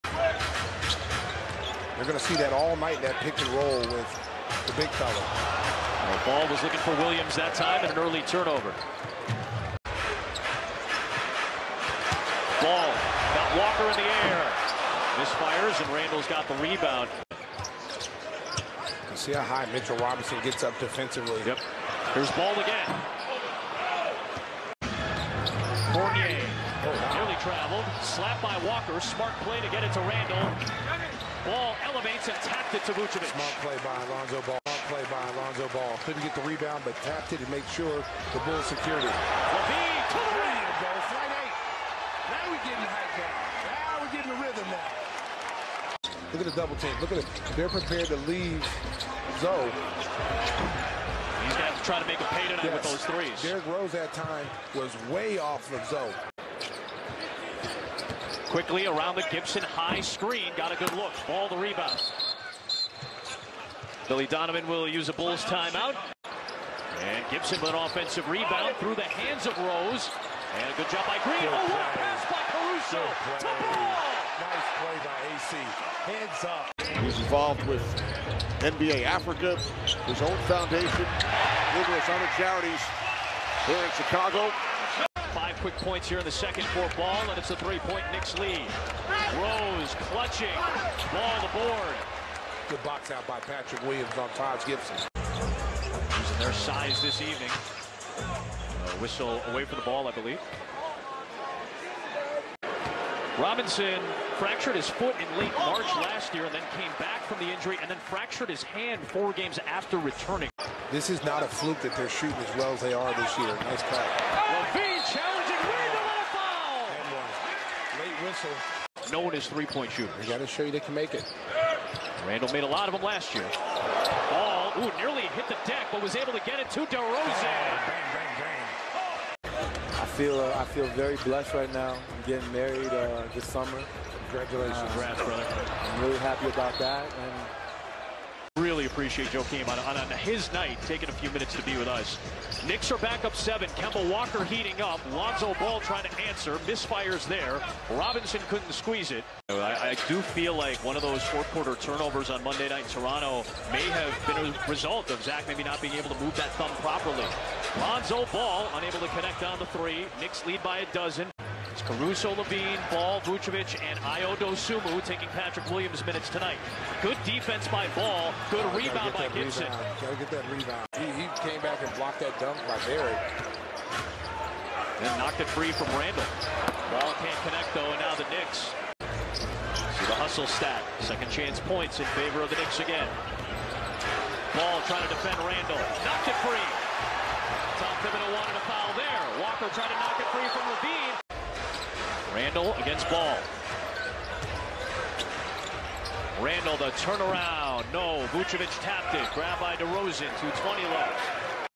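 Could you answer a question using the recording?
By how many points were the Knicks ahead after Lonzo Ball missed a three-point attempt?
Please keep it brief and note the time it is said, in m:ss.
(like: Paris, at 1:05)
12, at 2:40.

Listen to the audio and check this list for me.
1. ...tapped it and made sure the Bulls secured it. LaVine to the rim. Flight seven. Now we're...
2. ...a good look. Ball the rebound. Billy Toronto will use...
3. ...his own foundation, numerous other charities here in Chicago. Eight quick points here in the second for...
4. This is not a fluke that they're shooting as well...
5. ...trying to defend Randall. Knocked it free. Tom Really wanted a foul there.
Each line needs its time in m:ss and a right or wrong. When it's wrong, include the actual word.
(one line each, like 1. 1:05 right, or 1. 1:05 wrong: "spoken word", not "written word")
1. 0:37 wrong: "eight", not "seven"
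2. 1:00 wrong: "Donovan", not "Toronto"
3. 1:20 wrong: "Five", not "Eight"
4. 1:50 right
5. 3:04 wrong: "Thibodeau", not "Really".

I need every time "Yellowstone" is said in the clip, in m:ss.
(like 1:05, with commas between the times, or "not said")
not said.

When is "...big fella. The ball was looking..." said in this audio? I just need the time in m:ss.
0:04.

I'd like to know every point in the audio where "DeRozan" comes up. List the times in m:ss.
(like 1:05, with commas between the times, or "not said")
2:06, 3:19.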